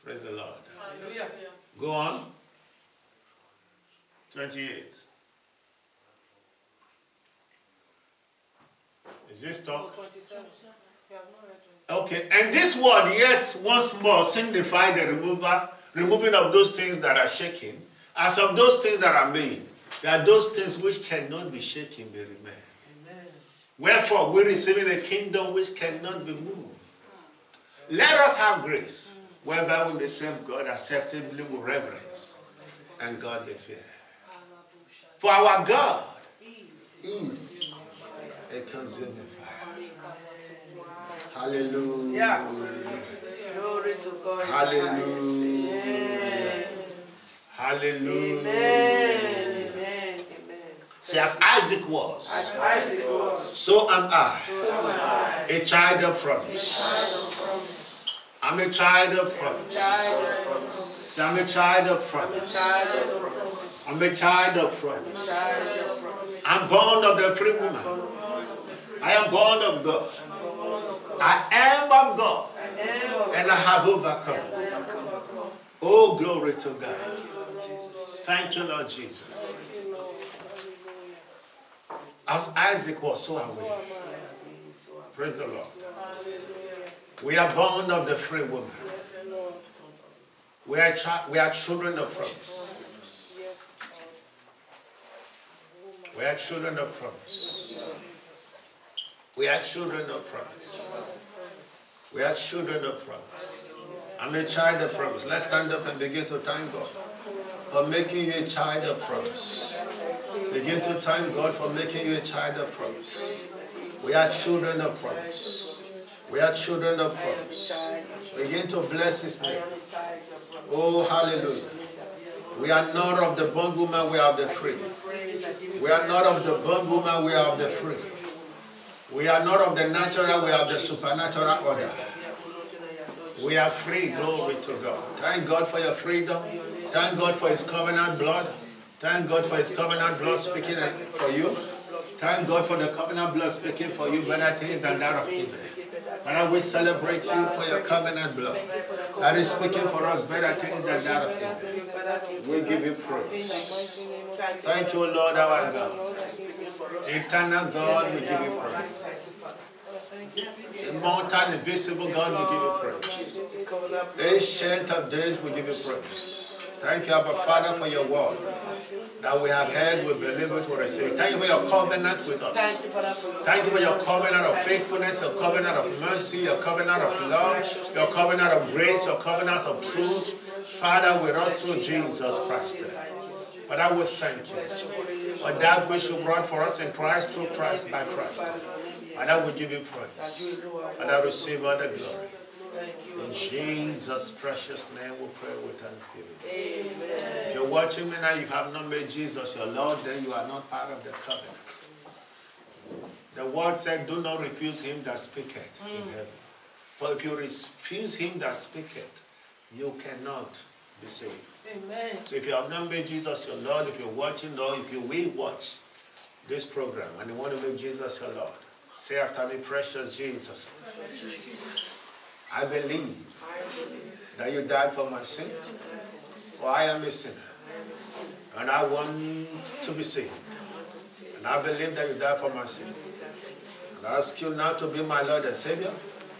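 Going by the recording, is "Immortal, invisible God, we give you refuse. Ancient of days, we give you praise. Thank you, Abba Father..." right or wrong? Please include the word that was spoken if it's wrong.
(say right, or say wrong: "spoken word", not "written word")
wrong: "praise", not "refuse".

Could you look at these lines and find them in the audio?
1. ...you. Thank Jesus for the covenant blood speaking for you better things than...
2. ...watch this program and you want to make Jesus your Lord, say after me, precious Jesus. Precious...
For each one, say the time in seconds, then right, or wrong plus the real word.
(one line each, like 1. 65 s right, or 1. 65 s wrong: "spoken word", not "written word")
1. 141 s wrong: "God", not "Jesus"
2. 215 s right.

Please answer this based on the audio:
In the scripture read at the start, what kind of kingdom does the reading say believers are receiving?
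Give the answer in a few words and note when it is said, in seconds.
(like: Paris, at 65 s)
A kingdom which cannot be moved, at 24 s.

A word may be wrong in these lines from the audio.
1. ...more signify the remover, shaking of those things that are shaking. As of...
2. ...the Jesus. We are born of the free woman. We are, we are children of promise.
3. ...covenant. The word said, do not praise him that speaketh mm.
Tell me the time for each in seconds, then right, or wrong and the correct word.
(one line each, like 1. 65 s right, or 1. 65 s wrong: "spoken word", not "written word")
1. 14 s wrong: "removing", not "shaking"
2. 85 s wrong: "Lord", not "Jesus"
3. 201 s wrong: "refuse", not "praise".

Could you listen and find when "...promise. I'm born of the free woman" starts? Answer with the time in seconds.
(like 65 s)
64 s.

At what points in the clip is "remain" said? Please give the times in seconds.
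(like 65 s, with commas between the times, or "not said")
22 s.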